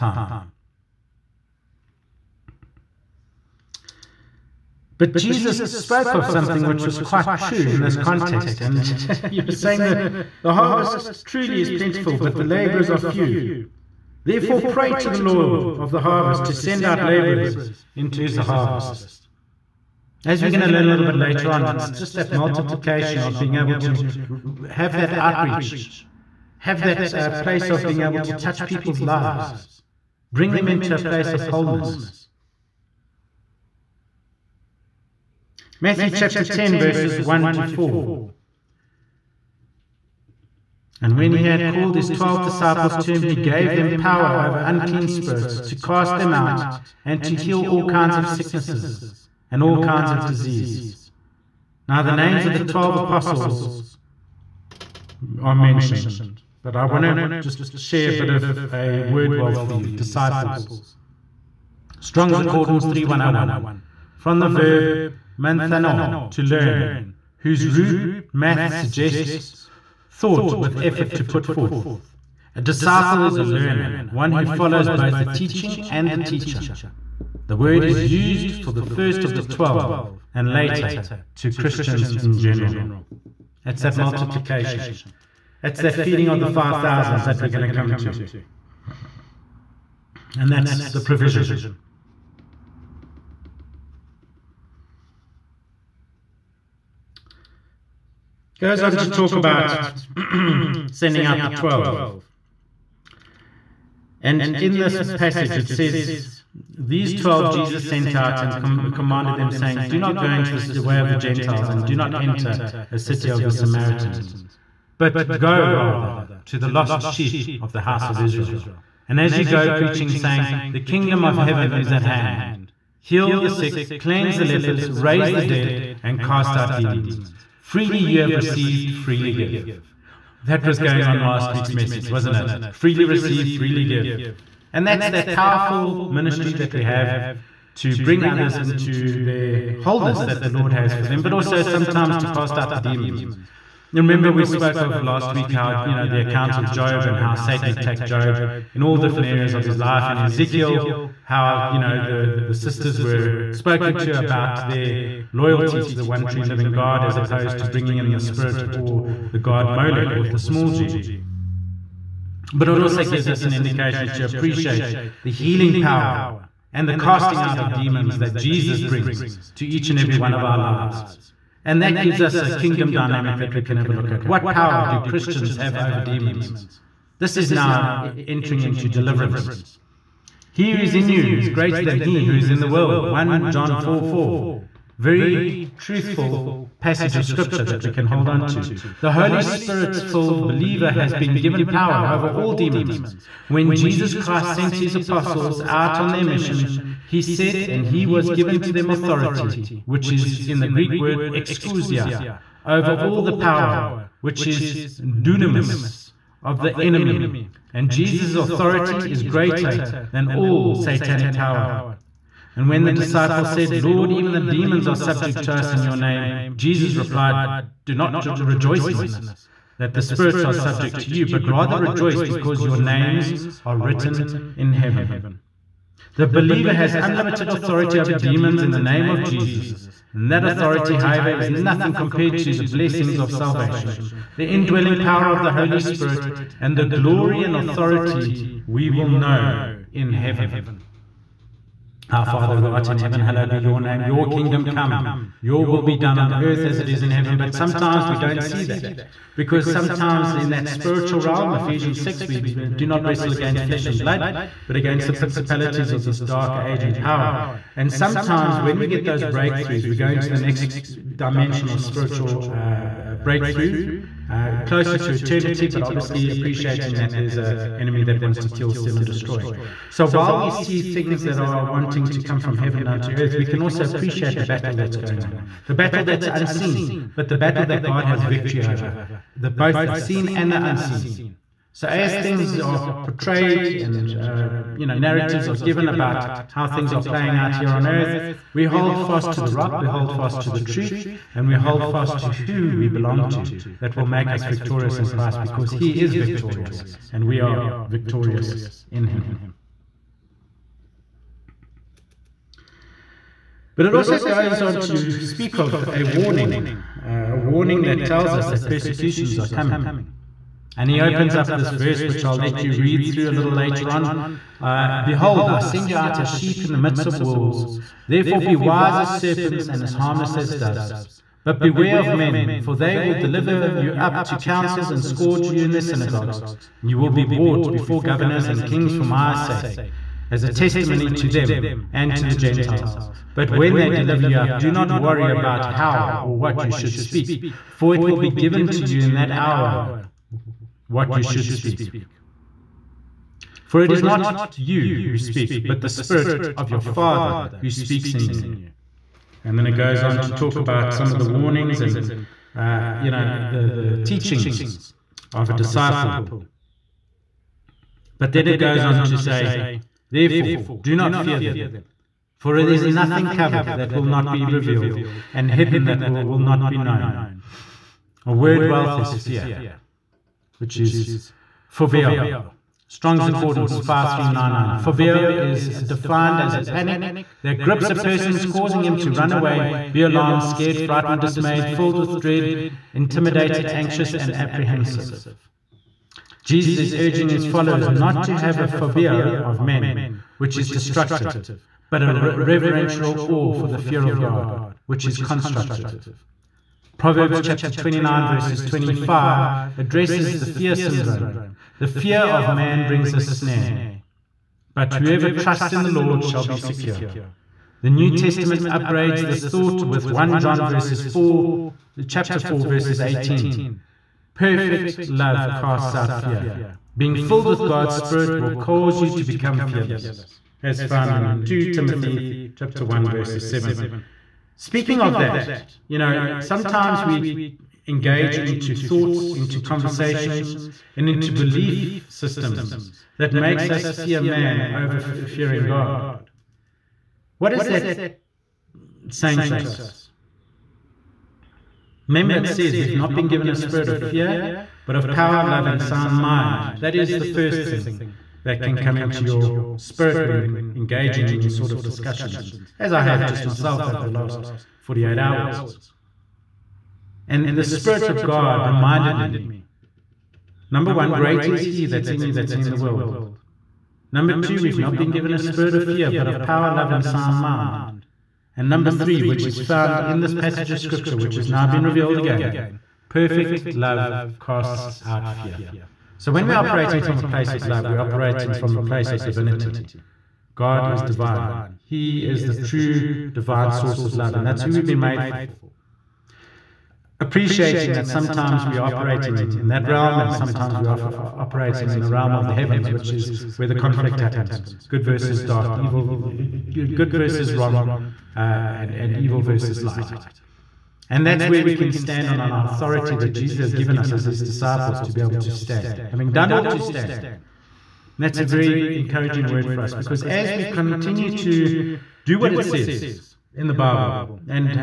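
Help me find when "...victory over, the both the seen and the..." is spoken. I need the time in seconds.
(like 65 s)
278 s.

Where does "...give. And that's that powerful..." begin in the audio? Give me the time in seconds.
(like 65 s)
133 s.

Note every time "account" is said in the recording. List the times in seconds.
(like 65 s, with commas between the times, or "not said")
146 s.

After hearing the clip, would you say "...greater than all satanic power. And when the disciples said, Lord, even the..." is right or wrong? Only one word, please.
right.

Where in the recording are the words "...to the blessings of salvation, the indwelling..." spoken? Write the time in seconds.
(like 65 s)
232 s.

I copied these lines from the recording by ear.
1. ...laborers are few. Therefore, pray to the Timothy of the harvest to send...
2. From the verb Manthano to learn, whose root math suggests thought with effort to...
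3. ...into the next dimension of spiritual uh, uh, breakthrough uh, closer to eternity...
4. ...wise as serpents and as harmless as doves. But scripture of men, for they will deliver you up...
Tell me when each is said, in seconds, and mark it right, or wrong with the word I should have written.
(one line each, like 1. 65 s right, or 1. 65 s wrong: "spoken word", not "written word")
1. 12 s wrong: "Lord", not "Timothy"
2. 64 s right
3. 260 s right
4. 318 s wrong: "beware", not "scripture".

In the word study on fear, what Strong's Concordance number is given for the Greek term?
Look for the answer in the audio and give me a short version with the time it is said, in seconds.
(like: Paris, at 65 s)
5399, at 373 s.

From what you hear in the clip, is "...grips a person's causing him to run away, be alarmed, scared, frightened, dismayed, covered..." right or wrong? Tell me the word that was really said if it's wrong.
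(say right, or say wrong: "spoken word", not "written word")
wrong: "filled", not "covered".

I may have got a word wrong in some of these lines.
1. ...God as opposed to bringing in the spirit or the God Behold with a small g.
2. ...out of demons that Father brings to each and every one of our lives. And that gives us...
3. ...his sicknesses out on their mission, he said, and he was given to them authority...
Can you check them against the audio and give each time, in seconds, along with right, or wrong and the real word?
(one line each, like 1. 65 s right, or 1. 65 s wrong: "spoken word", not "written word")
1. 156 s wrong: "Molech", not "Behold"
2. 167 s wrong: "Jesus", not "Father"
3. 194 s wrong: "apostles", not "sicknesses".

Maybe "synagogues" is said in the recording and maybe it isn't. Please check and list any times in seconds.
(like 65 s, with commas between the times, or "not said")
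325 s.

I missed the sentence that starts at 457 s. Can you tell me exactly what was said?
And the Spirit of God reminded me number one, great is He that's in you that's in the world.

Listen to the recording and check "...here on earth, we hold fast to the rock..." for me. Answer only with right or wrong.
right.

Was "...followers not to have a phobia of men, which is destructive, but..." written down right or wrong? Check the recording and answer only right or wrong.
right.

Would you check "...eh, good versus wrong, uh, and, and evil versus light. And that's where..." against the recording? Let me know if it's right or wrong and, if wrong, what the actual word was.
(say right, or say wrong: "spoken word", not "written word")
right.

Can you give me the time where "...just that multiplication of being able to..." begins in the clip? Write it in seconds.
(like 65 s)
21 s.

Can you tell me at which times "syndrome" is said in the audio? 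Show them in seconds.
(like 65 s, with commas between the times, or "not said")
400 s.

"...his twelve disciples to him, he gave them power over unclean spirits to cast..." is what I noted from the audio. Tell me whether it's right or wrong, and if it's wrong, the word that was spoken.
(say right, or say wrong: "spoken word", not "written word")
right.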